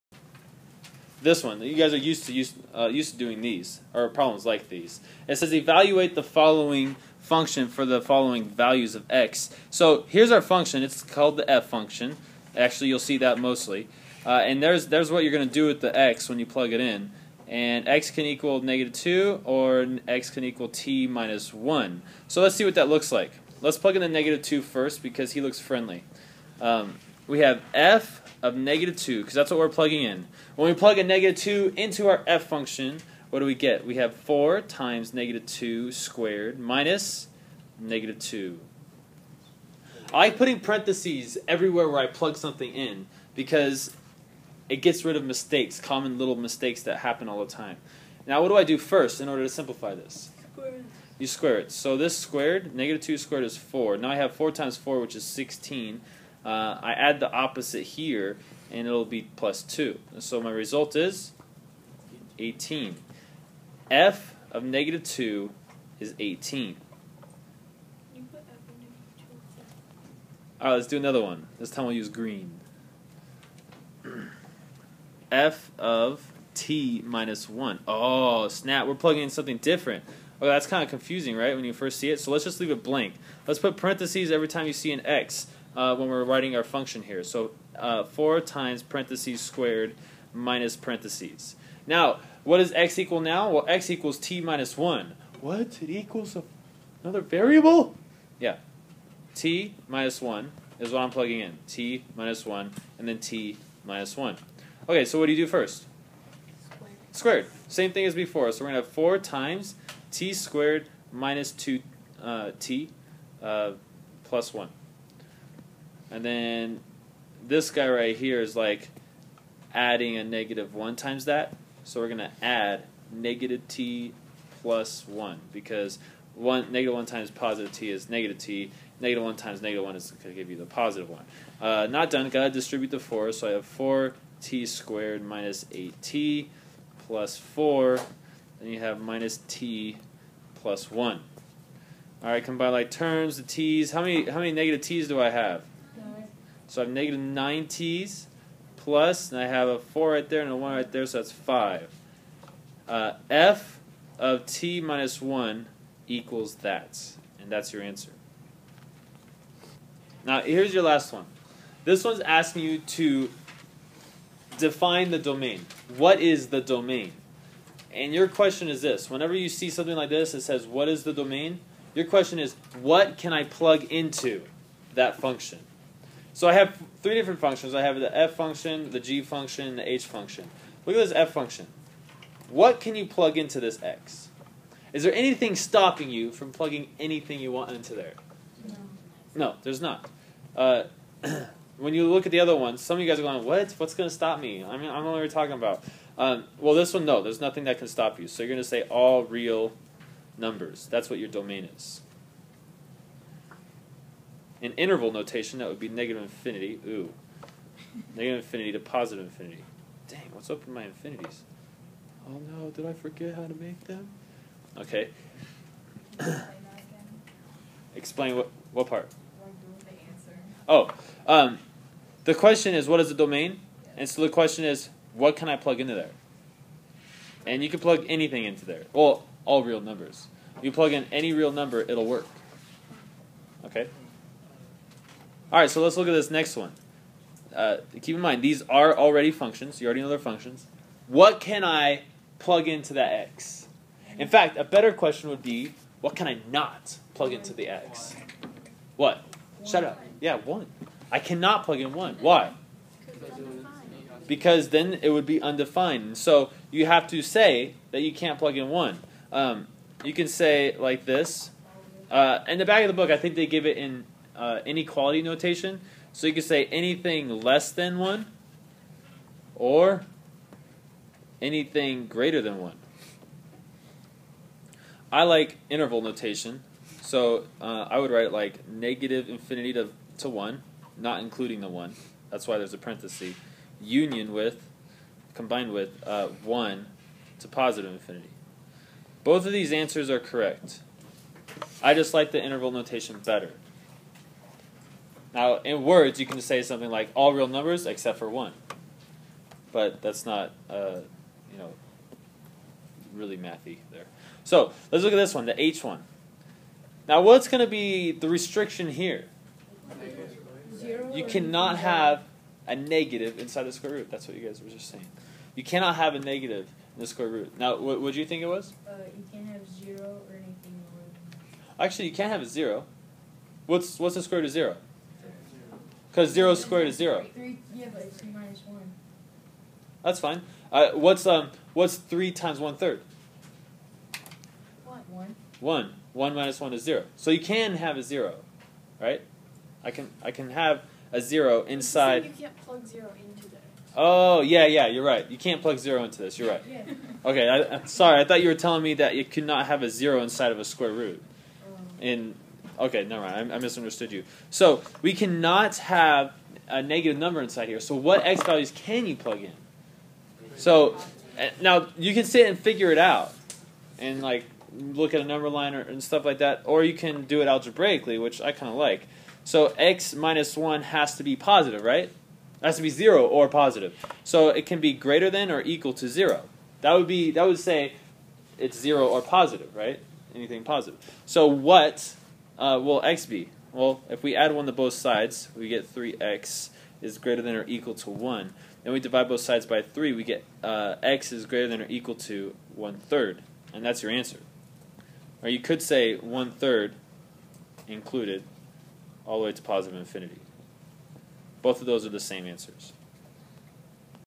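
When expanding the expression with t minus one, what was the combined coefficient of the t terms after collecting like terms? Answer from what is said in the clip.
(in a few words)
negative 9.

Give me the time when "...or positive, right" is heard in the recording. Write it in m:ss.
6:19.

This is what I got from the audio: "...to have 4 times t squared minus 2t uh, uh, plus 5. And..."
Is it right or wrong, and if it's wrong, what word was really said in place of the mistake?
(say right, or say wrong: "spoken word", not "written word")
wrong: "1", not "5".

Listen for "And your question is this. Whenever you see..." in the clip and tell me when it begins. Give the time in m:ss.
2:47.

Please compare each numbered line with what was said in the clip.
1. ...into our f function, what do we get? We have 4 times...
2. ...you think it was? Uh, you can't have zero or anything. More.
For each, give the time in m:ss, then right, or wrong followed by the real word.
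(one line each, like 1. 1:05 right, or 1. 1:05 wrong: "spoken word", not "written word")
1. 0:31 right
2. 5:18 right.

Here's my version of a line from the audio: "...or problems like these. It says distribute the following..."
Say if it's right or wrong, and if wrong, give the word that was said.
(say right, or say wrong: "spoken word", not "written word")
wrong: "evaluate", not "distribute".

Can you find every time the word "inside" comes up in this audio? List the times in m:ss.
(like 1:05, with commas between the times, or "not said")
5:13, 5:41, 5:50, 5:57.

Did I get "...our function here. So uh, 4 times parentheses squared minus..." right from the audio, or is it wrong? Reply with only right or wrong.
right.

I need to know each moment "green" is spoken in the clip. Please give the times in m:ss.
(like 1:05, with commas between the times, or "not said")
1:12.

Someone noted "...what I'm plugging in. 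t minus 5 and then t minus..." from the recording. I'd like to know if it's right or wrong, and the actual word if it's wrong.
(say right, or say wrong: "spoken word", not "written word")
wrong: "1", not "5".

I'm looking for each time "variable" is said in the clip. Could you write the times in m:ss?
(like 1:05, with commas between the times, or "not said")
1:37.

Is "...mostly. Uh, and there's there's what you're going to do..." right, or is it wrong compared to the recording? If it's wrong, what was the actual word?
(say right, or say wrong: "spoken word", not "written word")
right.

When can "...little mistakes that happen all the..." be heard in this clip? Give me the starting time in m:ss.
0:46.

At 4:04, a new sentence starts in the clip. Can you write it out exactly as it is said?
In fact, a better question would be, what can I not plug into the x?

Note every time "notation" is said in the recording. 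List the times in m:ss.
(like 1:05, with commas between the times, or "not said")
3:25, 4:25, 4:36, 4:52.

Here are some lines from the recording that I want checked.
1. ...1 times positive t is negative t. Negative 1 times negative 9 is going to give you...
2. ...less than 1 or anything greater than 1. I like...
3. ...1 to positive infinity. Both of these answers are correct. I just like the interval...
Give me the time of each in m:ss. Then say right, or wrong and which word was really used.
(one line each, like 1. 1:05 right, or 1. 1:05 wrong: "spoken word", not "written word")
1. 2:06 wrong: "1", not "9"
2. 4:27 right
3. 4:46 right.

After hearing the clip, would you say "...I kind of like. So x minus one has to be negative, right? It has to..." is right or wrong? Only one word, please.
wrong.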